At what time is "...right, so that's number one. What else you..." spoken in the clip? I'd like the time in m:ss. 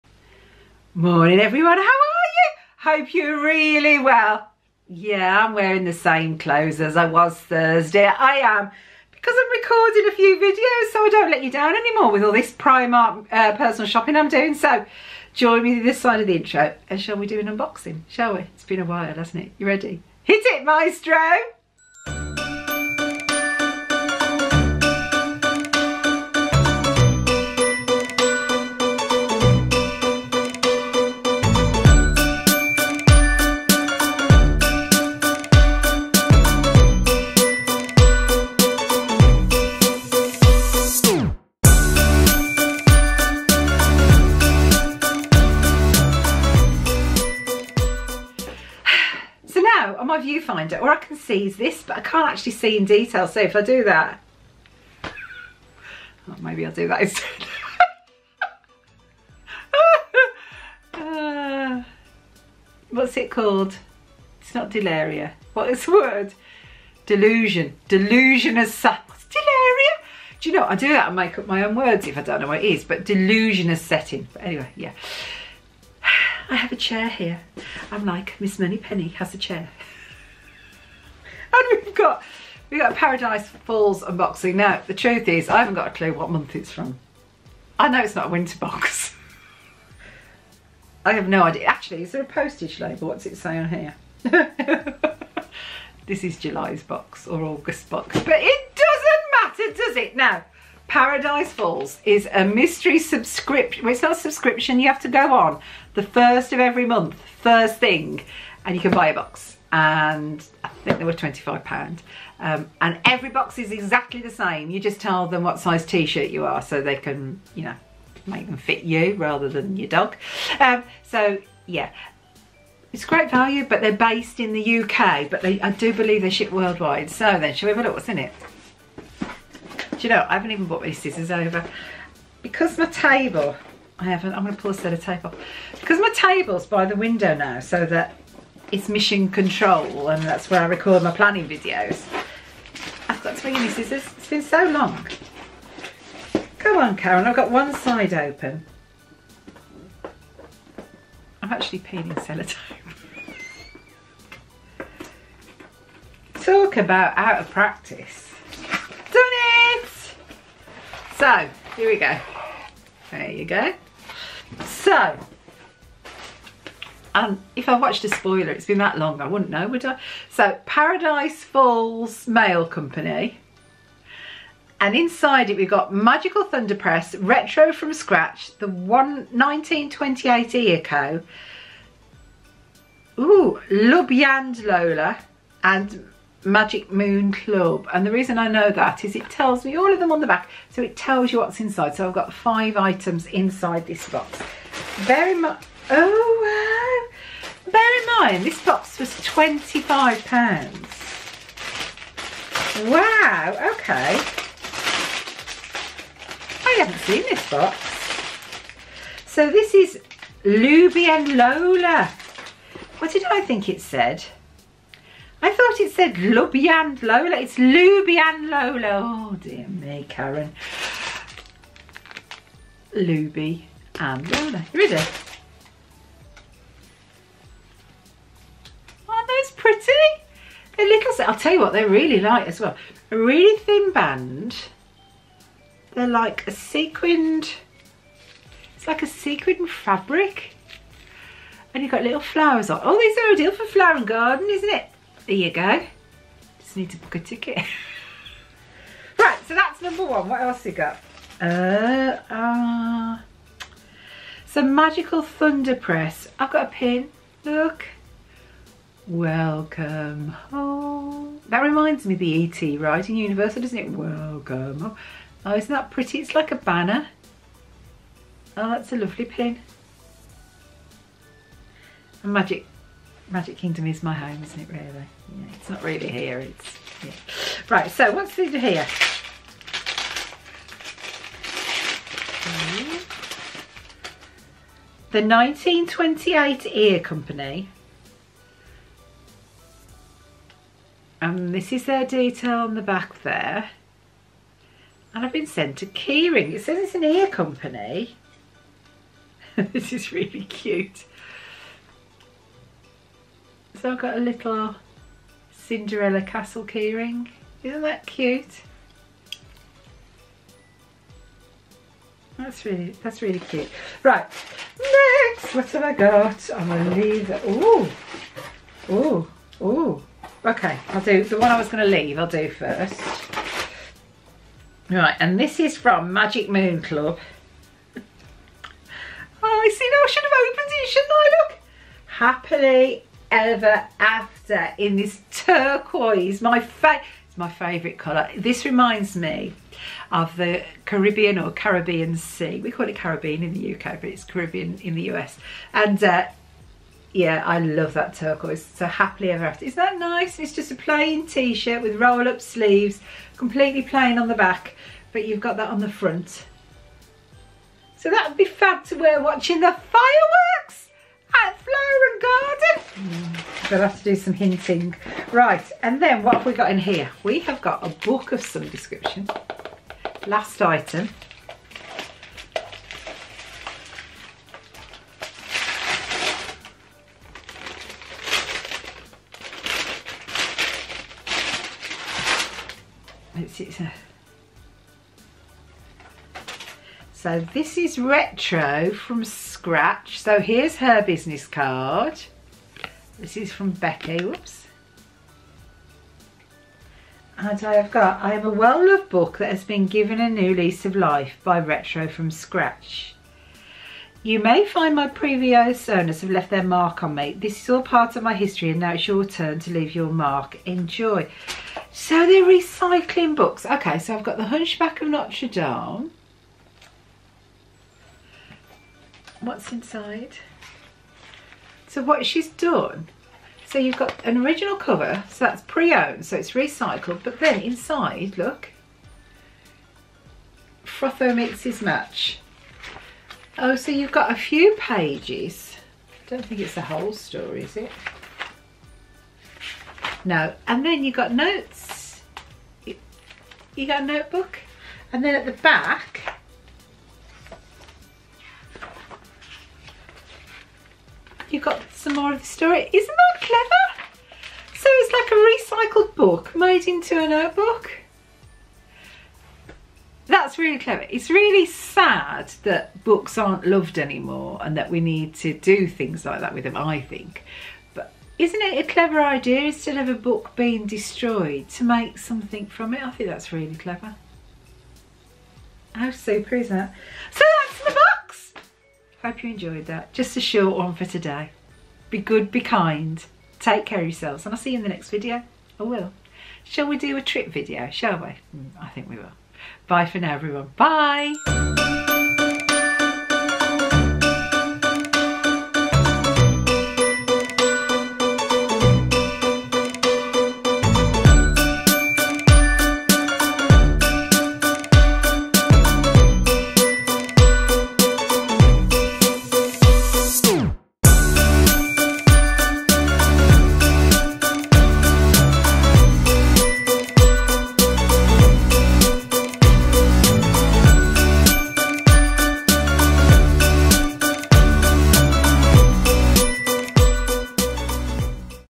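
4:09.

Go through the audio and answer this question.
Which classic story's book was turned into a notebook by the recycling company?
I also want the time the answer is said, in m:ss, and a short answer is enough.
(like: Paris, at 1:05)
The Hunchback of Notre Dame, at 6:54.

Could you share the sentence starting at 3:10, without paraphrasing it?
So it tells you what's inside.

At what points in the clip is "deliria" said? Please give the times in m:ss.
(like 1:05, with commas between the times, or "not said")
1:04, 1:08.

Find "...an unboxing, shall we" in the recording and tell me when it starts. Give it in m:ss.
0:17.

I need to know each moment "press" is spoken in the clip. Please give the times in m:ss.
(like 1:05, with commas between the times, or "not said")
2:56, 4:15.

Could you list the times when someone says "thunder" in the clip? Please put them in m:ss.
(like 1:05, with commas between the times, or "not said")
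2:56, 4:15.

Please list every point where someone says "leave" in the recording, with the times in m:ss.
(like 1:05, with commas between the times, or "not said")
5:16, 5:21, 6:49.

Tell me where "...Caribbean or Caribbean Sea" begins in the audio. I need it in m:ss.
5:40.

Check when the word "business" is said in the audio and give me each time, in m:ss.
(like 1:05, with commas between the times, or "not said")
6:31.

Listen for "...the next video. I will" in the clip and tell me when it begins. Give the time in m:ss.
8:04.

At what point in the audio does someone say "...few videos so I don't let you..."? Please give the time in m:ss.
0:10.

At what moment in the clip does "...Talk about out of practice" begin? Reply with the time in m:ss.
2:36.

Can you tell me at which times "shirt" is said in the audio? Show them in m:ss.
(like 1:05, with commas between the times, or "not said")
1:55, 5:51.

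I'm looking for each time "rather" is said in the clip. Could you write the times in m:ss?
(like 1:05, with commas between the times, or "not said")
1:59.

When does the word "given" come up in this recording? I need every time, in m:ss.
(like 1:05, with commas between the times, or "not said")
6:39.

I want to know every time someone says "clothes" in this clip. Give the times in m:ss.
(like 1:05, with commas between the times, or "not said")
0:06.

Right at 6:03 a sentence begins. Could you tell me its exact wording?
they'll have to do some hinting.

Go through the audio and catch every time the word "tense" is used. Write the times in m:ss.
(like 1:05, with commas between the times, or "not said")
not said.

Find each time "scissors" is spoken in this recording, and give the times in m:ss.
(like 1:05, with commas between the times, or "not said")
2:10, 2:23.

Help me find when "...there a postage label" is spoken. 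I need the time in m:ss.
1:32.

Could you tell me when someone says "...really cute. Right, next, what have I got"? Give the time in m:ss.
5:13.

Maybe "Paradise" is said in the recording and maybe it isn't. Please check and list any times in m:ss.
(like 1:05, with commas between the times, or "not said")
1:22, 1:40, 2:50.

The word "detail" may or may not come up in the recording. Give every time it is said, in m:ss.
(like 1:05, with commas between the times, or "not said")
0:52, 4:52.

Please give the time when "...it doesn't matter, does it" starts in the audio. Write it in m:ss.
1:38.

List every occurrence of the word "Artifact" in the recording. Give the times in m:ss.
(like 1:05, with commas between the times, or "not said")
not said.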